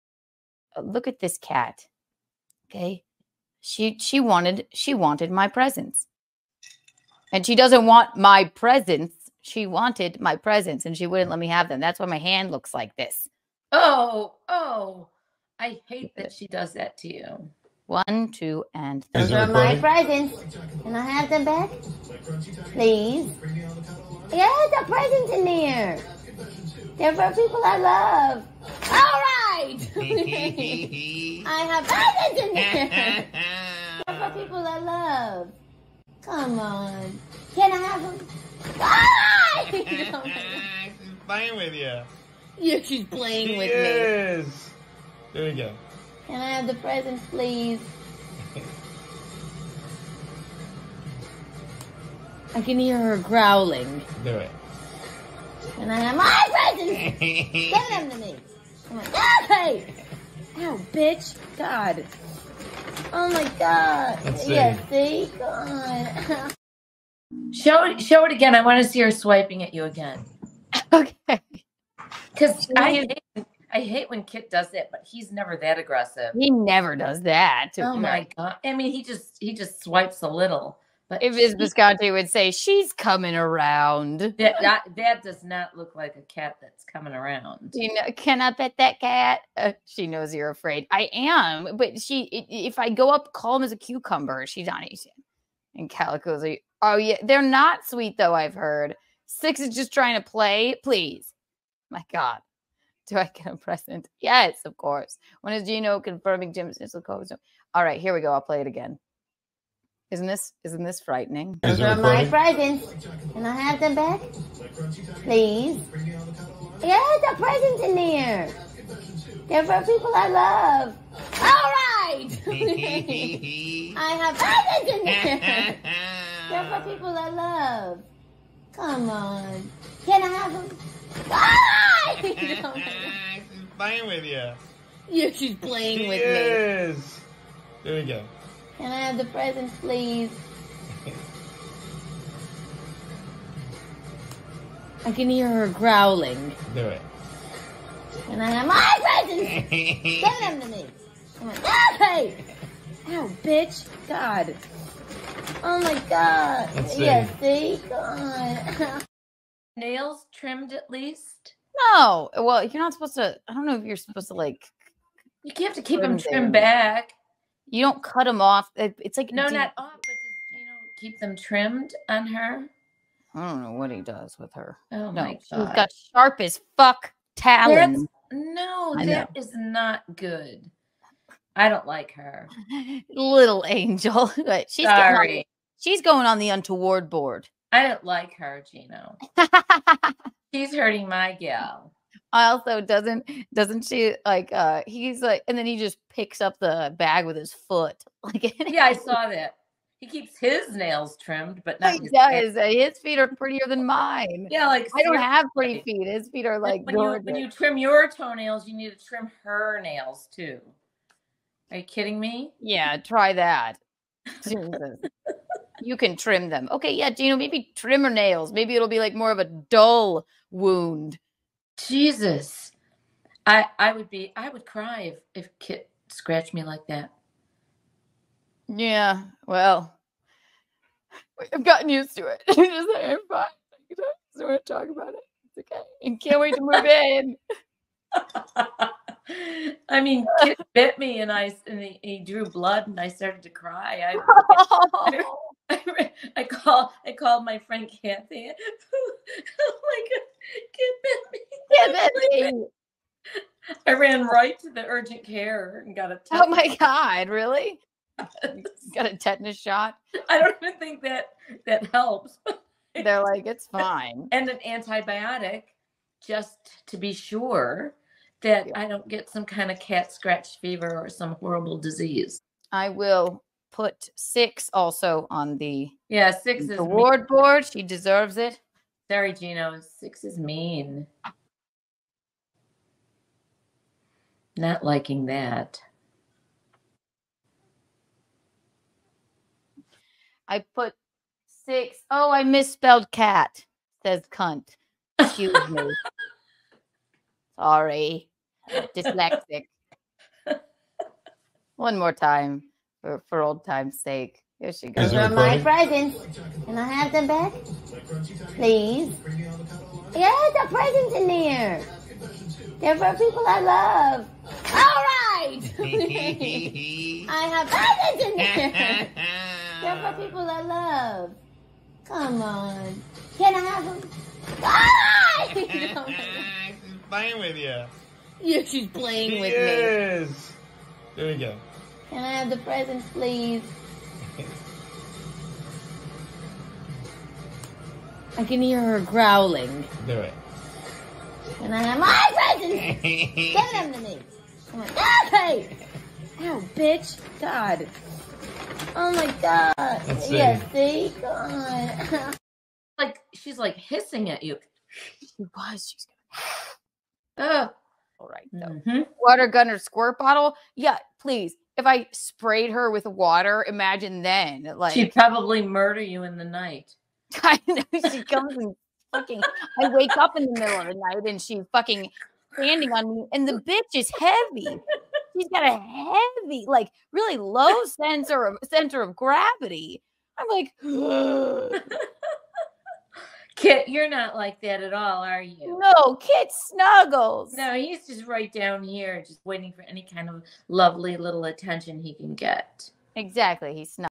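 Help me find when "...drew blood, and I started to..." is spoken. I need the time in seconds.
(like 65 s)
242 s.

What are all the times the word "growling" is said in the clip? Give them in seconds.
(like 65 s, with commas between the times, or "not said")
53 s, 145 s, 339 s.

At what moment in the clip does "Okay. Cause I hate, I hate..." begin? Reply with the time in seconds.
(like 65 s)
70 s.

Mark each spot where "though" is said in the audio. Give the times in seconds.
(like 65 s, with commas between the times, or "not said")
98 s, 358 s.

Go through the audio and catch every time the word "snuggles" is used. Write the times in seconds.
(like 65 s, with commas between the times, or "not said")
386 s, 393 s.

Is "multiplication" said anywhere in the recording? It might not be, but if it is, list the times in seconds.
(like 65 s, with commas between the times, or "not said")
not said.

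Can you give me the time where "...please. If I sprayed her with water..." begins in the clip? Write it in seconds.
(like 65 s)
361 s.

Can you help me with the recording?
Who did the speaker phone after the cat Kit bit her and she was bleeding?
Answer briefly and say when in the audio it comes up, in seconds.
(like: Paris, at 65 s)
Kathy, at 248 s.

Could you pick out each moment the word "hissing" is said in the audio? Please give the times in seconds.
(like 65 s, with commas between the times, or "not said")
353 s.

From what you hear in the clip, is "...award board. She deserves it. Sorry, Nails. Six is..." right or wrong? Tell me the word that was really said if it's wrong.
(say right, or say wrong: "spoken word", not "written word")
wrong: "Gino", not "Nails".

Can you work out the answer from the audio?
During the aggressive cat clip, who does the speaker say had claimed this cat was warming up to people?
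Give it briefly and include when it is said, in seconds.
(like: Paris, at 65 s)
Miss Visconti, at 81 s.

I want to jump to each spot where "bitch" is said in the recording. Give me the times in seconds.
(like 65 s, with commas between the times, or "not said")
60 s, 153 s, 346 s, 373 s.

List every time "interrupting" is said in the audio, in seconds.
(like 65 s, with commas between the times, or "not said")
not said.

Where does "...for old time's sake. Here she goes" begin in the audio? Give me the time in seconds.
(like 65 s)
303 s.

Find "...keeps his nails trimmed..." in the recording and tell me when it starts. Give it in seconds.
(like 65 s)
200 s.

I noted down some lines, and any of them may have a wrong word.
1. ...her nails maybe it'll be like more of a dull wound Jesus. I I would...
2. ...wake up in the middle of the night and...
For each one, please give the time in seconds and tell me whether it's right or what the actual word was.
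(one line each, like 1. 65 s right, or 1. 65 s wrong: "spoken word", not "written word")
1. 218 s right
2. 369 s right.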